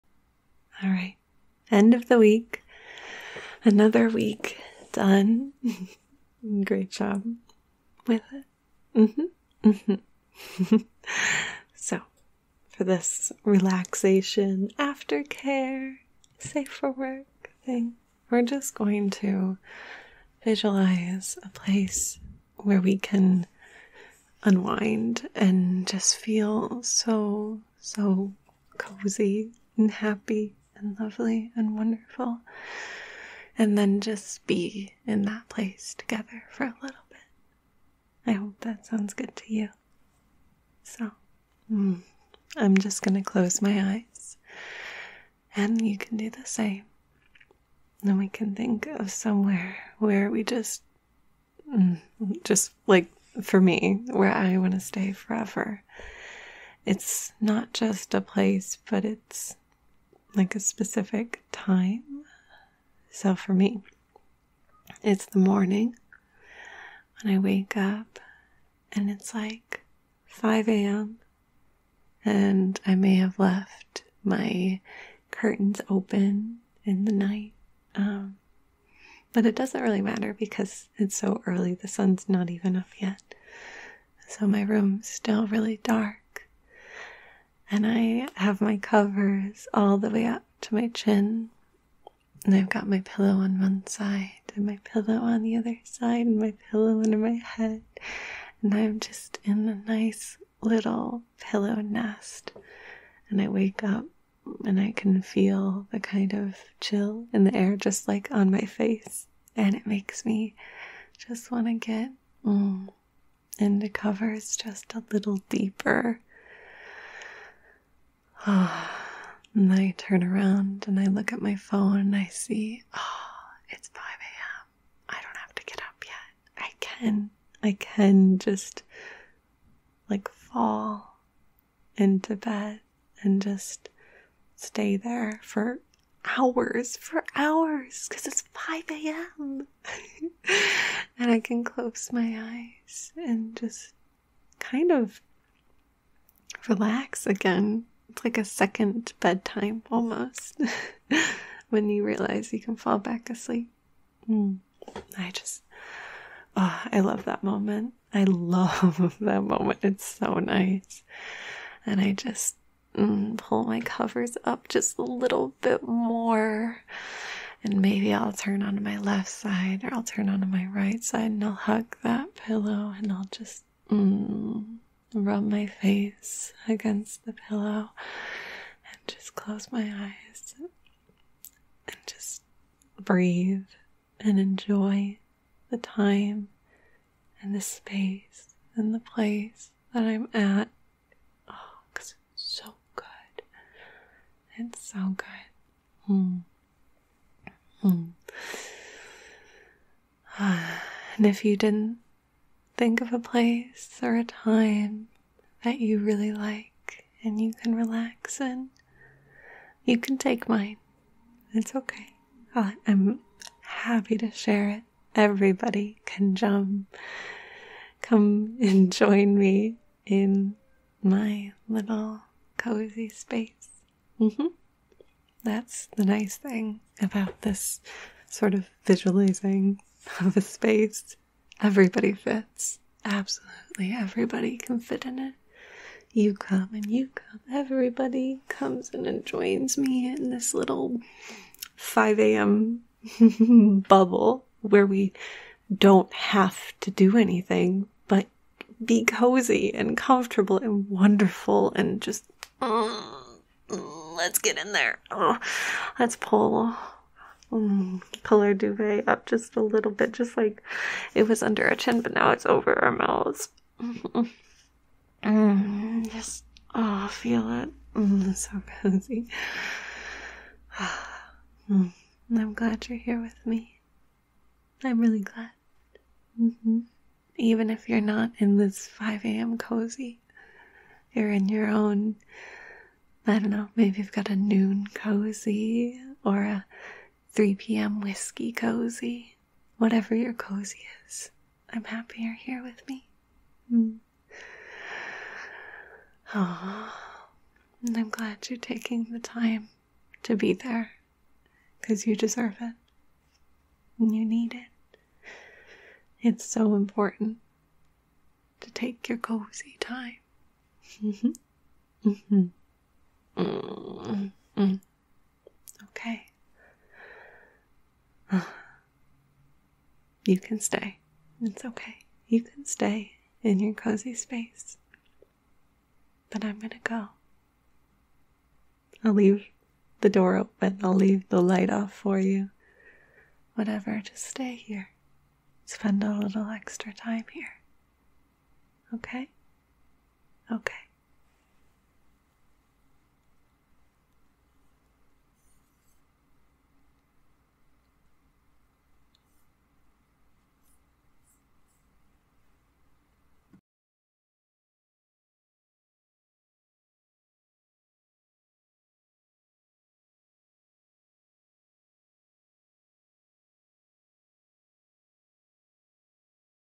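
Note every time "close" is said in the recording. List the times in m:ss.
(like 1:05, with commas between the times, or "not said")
0:43, 2:21, 2:59.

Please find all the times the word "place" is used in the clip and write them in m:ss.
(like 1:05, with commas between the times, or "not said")
0:21, 0:35, 0:58, 3:08, 3:23.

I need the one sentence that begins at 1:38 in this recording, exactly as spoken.
And I'm just in a nice little pillow nest.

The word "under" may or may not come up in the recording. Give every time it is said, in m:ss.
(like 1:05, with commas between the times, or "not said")
1:37, 4:21.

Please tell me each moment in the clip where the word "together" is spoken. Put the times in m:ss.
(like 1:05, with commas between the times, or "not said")
0:35.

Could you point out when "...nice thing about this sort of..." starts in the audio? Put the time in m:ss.
3:46.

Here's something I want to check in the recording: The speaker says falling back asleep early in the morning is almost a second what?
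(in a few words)
bedtime.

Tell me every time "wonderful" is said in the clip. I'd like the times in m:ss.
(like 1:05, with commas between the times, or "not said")
0:31, 4:10.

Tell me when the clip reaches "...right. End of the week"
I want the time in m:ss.
0:00.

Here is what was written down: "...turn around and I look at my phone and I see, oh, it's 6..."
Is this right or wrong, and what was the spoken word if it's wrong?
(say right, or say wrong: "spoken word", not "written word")
wrong: "5", not "6".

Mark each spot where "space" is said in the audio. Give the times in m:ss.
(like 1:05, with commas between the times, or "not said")
3:07, 3:43, 3:50, 5:24.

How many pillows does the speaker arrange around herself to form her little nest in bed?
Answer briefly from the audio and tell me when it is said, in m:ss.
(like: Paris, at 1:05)
3, at 1:32.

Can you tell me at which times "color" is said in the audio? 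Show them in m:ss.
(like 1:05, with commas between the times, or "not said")
4:18.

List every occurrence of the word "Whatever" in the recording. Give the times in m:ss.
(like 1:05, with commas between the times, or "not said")
4:49, 5:33.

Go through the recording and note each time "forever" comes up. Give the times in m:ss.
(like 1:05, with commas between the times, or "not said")
0:55.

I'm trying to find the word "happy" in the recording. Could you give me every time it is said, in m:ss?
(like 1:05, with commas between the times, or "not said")
0:29, 3:33, 4:51.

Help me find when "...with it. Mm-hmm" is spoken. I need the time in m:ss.
0:08.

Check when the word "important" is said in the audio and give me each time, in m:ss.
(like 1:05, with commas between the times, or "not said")
5:06.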